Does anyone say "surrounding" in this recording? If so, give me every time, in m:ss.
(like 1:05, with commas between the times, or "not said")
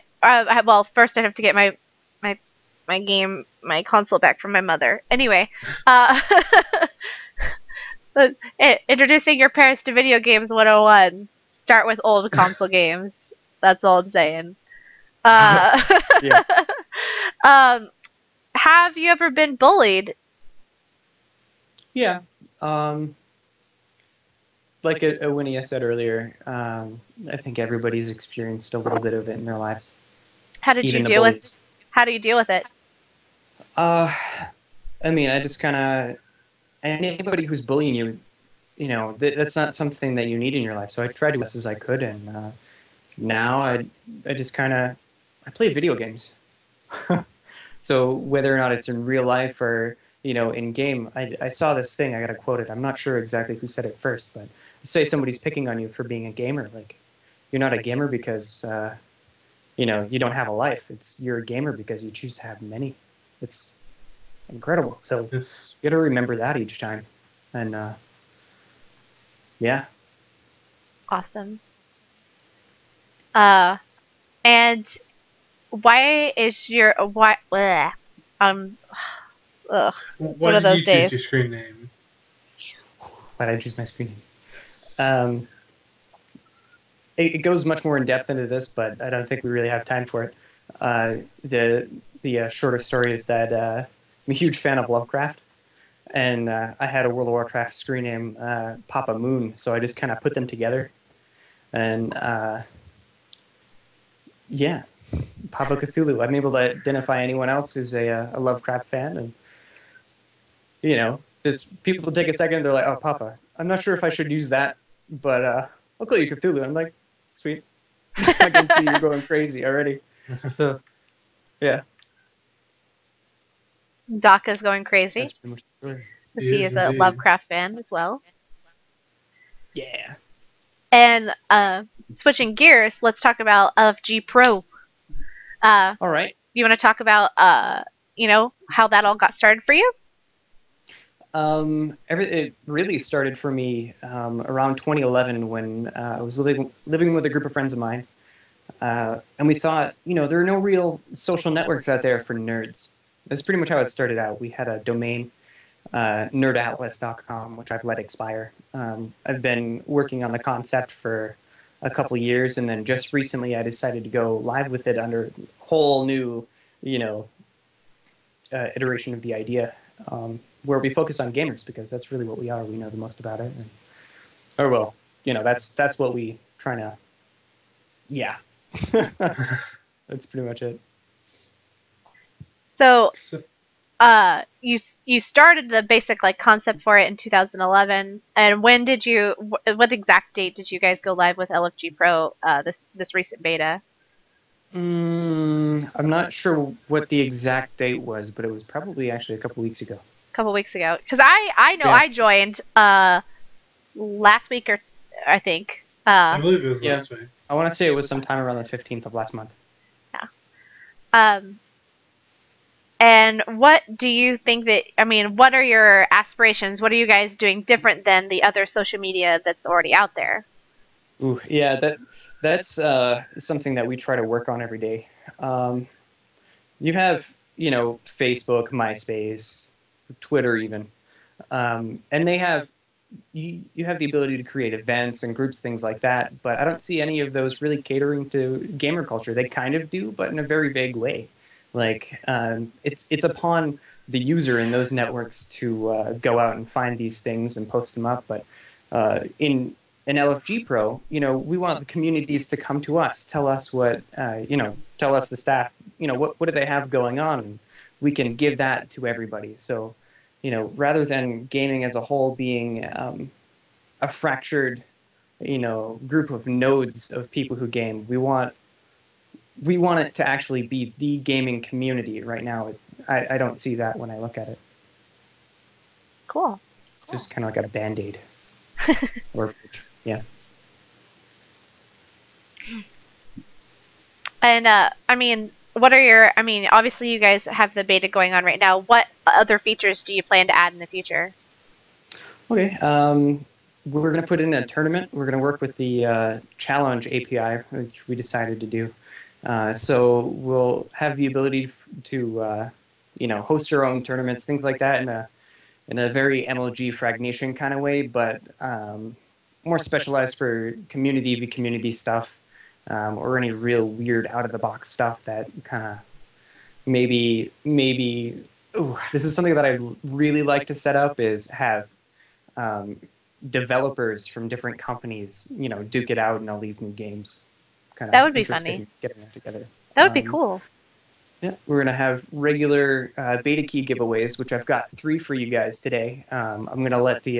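not said.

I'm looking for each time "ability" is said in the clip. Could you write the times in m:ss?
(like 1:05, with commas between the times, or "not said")
3:54, 5:01.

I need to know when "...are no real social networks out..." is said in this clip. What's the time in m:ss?
2:30.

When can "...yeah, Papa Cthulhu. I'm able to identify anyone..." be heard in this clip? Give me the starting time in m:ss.
1:44.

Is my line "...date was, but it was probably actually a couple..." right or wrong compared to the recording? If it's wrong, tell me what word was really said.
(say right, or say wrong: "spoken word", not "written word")
right.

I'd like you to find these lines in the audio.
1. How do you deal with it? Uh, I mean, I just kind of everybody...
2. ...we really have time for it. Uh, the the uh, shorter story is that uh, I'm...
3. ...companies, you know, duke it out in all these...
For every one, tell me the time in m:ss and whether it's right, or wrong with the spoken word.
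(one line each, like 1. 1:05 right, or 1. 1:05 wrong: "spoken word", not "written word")
1. 0:31 wrong: "anybody", not "everybody"
2. 1:29 right
3. 5:24 right.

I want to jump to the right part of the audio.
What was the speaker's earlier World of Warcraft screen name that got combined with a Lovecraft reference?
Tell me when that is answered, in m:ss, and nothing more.
1:38.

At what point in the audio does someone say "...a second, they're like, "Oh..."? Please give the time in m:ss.
1:52.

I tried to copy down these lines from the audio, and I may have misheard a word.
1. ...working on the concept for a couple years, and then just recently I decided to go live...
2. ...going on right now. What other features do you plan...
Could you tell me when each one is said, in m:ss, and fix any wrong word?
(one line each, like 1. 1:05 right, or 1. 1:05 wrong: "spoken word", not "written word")
1. 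2:39 right
2. 4:48 right.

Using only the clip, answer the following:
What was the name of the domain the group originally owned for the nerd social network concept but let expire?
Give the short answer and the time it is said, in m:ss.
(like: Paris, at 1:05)
nerdatlas.com, at 2:36.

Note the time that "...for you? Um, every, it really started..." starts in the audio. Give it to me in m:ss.
2:19.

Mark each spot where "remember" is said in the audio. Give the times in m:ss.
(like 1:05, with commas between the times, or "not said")
1:05.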